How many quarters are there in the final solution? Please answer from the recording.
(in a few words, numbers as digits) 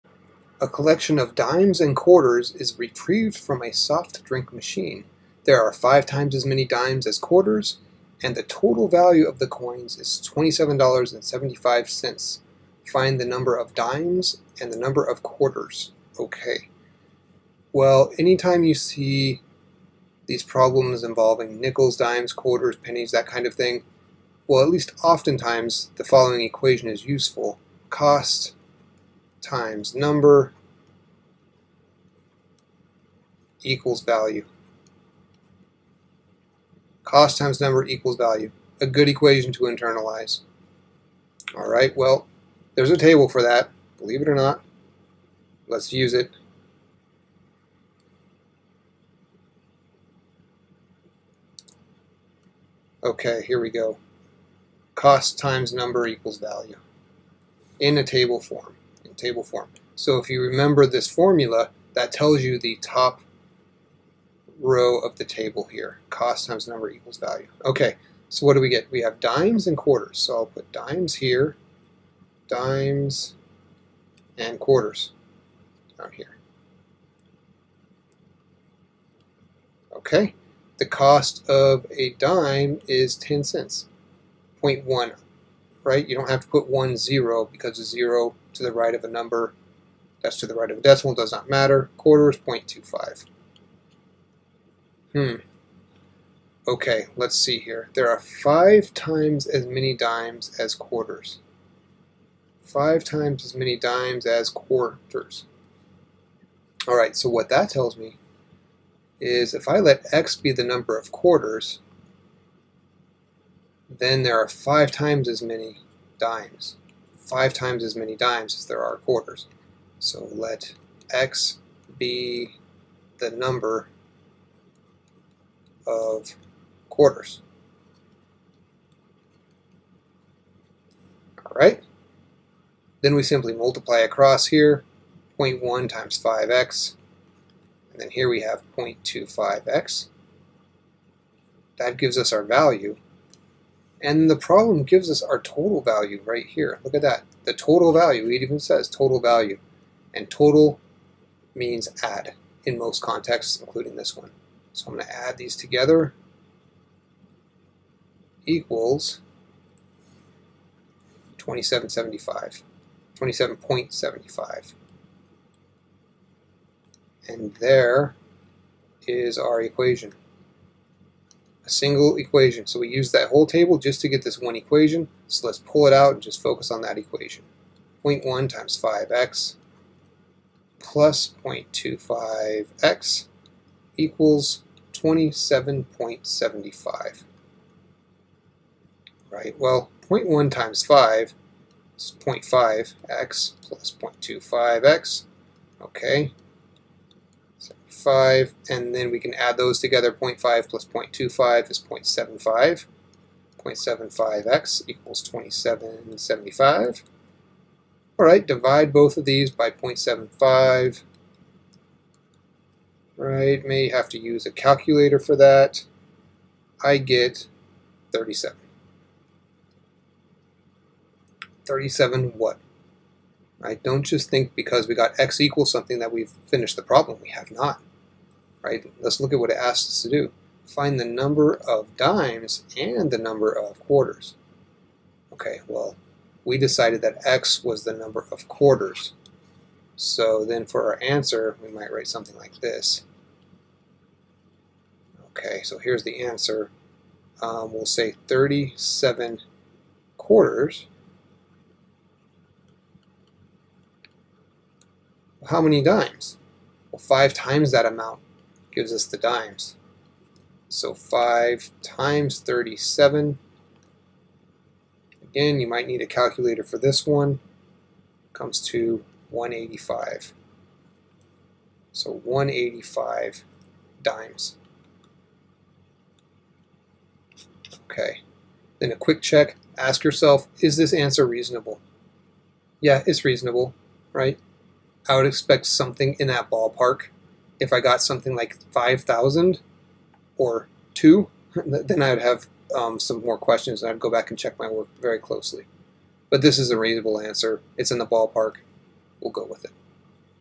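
37.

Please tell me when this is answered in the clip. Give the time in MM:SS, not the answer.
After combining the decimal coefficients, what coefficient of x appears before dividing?
03:23.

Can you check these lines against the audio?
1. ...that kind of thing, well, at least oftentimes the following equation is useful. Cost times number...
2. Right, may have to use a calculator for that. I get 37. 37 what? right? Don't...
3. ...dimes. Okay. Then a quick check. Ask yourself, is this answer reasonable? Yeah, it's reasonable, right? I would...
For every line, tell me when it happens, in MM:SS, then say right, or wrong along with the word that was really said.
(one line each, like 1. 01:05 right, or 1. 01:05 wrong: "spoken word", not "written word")
1. 00:23 right
2. 03:33 right
3. 04:34 right.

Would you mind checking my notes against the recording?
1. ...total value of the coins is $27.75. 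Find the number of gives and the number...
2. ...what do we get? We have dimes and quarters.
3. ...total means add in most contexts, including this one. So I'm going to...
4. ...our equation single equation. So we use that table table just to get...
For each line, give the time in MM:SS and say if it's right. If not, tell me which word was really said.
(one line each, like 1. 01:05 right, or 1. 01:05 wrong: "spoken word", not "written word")
1. 00:08 wrong: "dimes", not "gives"
2. 01:08 right
3. 02:30 right
4. 02:49 wrong: "whole", not "table".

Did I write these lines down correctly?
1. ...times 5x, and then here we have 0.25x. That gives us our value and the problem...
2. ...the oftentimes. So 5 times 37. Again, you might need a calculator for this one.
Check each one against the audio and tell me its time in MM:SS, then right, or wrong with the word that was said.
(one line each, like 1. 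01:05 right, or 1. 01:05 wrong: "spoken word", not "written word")
1. 02:15 right
2. 04:19 wrong: "dimes", not "oftentimes".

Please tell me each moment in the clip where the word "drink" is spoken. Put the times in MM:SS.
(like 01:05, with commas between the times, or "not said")
00:04.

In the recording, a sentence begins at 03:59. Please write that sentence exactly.
So then for our answer, we might write something like this.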